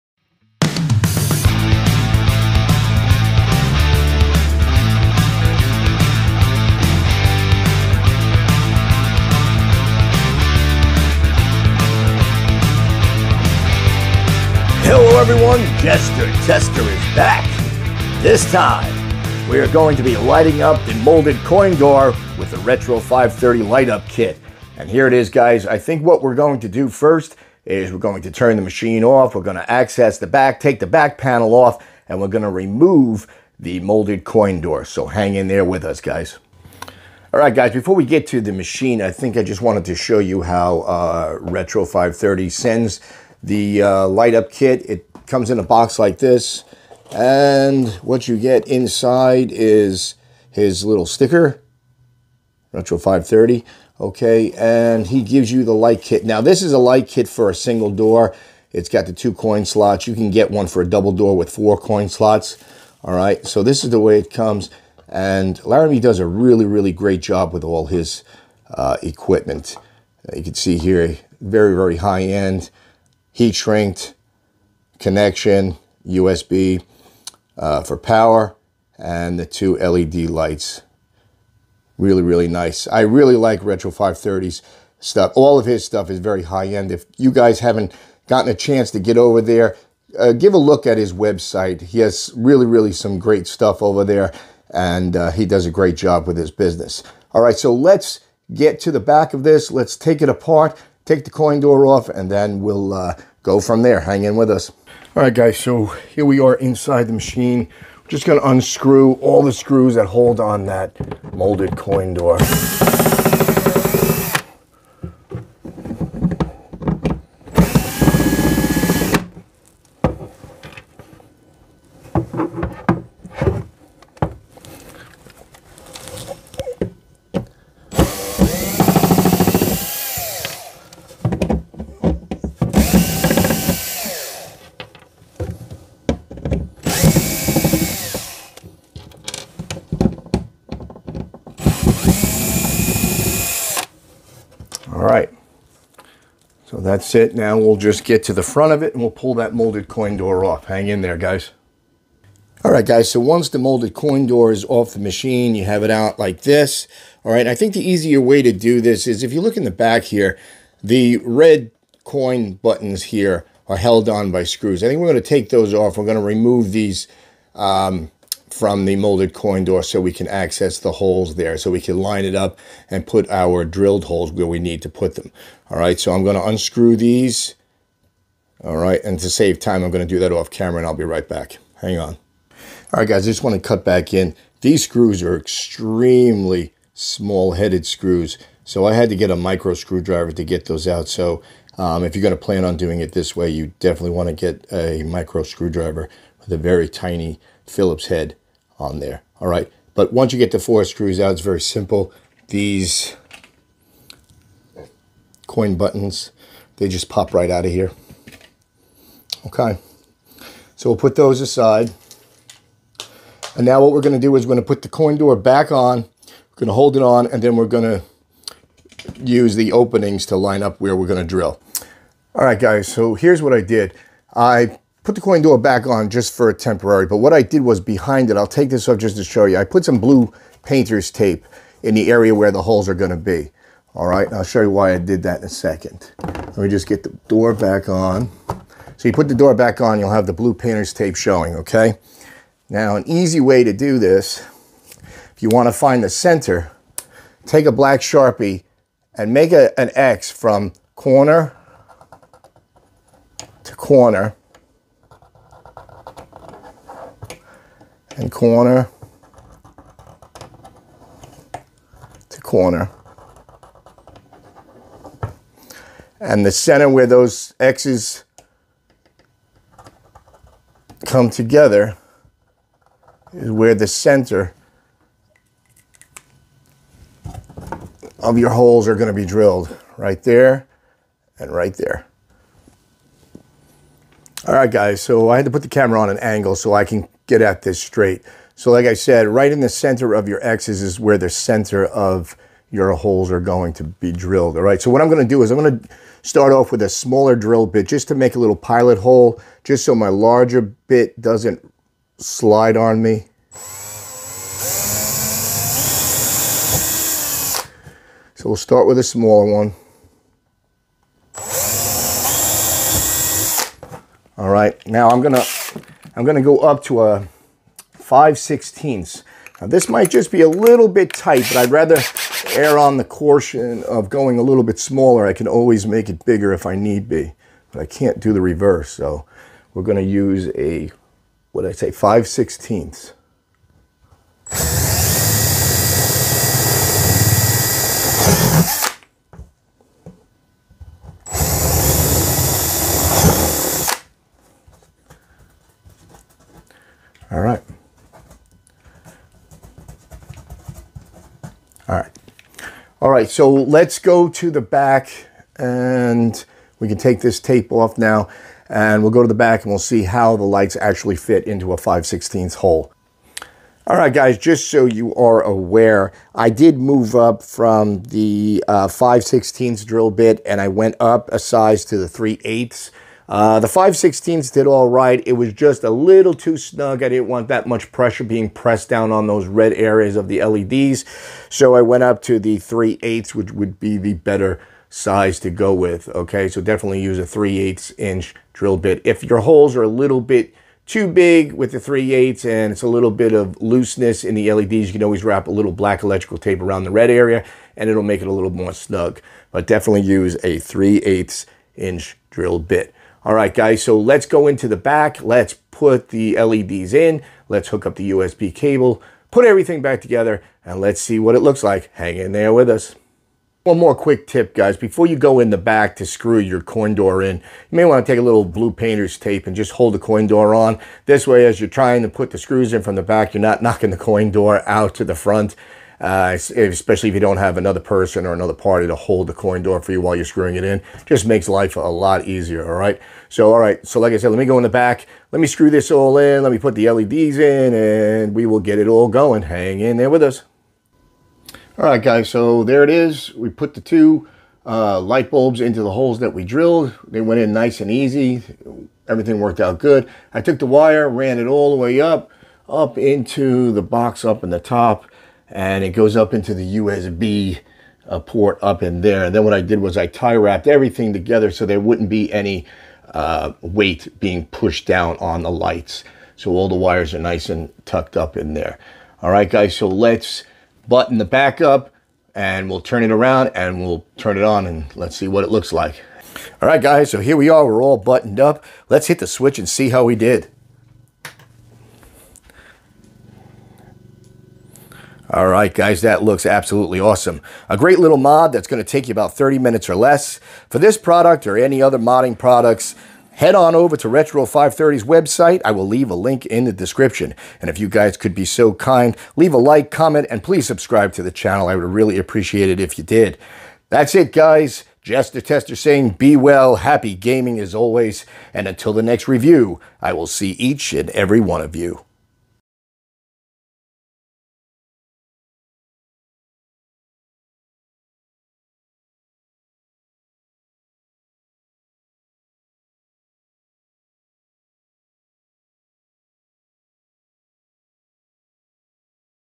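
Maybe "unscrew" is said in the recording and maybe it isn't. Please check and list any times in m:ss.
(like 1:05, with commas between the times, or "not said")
1:48, 2:56.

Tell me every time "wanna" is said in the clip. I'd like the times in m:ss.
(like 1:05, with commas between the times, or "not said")
3:03, 4:05.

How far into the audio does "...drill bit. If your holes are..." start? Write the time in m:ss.
6:28.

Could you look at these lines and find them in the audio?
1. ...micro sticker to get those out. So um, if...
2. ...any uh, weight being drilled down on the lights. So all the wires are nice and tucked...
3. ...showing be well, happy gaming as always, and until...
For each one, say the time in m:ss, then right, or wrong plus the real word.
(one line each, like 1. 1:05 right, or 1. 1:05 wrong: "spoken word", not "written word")
1. 3:09 wrong: "screwdriver", not "sticker"
2. 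7:42 wrong: "pushed", not "drilled"
3. 8:25 wrong: "saying", not "showing".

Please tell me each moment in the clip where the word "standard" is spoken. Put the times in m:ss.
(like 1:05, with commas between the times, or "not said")
not said.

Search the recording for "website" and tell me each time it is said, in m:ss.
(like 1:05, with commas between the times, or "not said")
1:31, 8:15.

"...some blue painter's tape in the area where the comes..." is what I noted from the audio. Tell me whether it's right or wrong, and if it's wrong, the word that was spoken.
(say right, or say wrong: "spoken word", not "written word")
wrong: "holes", not "comes".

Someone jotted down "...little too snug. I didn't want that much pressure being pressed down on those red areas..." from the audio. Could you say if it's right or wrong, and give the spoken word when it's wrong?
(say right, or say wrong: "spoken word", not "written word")
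right.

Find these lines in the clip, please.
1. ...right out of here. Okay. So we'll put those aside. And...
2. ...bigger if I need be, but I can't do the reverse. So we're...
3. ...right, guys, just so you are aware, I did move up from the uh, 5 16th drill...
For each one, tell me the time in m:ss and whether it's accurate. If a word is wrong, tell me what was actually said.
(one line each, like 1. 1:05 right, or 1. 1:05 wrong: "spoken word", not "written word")
1. 3:27 right
2. 5:26 right
3. 6:03 right.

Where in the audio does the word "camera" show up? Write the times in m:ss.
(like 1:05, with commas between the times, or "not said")
3:00, 4:45.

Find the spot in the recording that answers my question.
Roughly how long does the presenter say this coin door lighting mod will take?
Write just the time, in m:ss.
8:09.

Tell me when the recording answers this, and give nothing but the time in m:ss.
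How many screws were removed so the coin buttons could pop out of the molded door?
3:20.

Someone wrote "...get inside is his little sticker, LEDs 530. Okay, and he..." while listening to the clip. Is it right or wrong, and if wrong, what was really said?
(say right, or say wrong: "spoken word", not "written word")
wrong: "Retro", not "LEDs".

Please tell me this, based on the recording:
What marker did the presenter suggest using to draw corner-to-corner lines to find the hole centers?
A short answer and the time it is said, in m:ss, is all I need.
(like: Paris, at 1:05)
black Sharpie, at 4:07.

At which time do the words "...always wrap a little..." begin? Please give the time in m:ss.
6:35.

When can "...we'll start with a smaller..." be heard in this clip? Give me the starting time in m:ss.
5:08.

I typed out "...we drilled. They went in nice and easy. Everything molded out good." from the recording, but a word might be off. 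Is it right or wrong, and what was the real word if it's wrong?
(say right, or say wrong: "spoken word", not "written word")
wrong: "worked", not "molded".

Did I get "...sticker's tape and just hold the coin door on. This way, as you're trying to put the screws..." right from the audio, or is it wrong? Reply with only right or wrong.
wrong.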